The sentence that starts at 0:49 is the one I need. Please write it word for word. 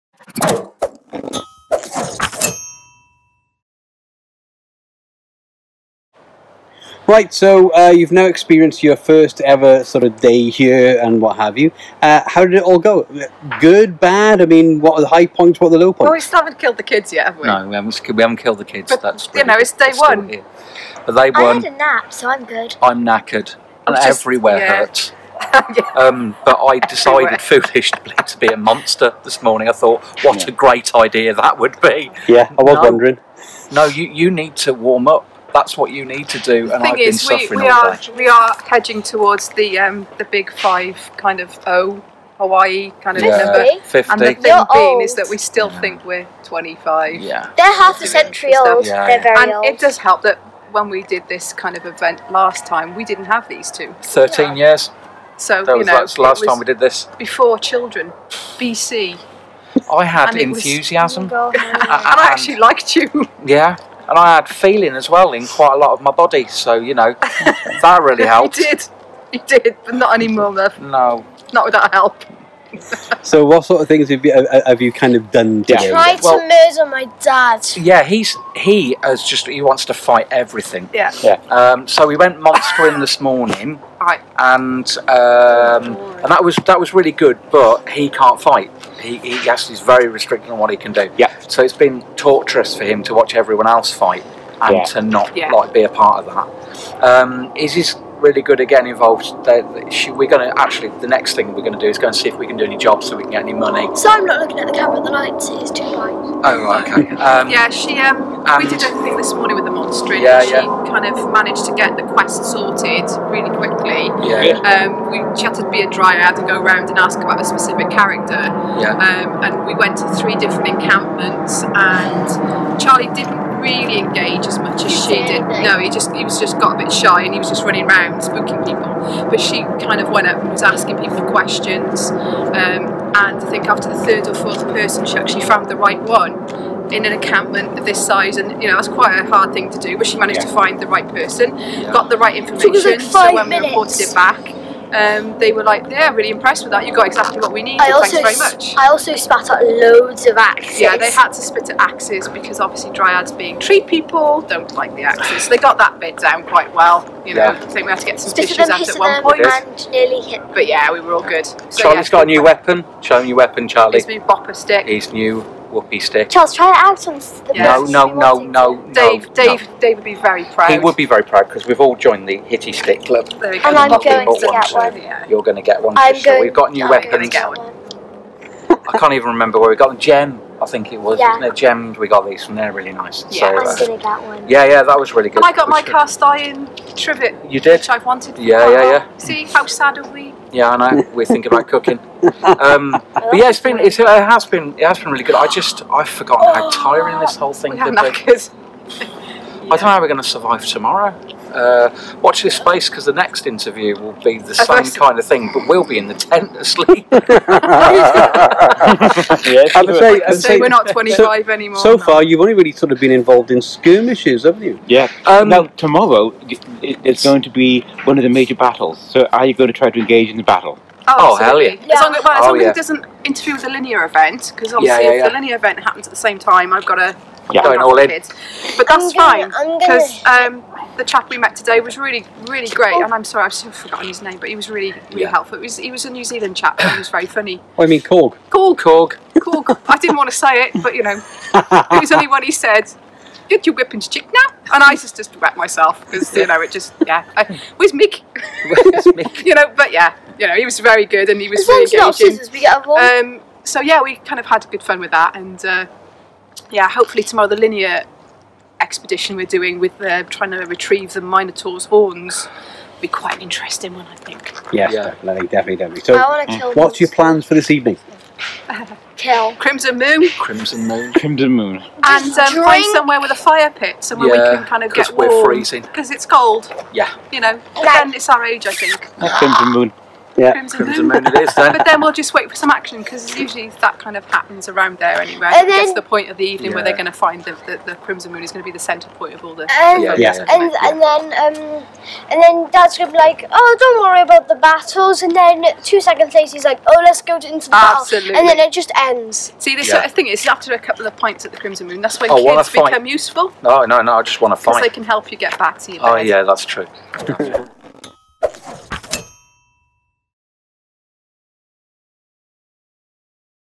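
it does help that when we did this kind of event last time, we didn't have these two.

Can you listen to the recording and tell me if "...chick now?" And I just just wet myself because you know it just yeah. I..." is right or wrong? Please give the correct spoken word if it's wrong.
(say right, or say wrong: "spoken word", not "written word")
right.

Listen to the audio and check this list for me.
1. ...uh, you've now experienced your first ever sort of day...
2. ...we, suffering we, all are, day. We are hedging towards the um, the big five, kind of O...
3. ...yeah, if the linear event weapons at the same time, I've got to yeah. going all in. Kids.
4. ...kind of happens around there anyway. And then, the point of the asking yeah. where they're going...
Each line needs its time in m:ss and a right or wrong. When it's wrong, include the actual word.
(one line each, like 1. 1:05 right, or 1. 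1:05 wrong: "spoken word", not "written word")
1. 0:07 right
2. 0:37 right
3. 3:45 wrong: "happens", not "weapons"
4. 4:43 wrong: "evening", not "asking".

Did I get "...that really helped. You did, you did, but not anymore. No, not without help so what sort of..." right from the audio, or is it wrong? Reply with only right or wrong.
right.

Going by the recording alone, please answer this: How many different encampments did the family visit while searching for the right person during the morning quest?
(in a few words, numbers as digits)
3.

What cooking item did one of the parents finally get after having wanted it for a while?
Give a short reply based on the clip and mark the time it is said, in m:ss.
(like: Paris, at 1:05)
Cast iron trivet, at 3:05.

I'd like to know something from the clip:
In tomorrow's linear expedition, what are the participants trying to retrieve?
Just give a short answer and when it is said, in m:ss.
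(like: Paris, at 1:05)
The Minotaur's horns, at 4:21.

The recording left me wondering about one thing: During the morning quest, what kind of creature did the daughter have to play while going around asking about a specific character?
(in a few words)
Dryad.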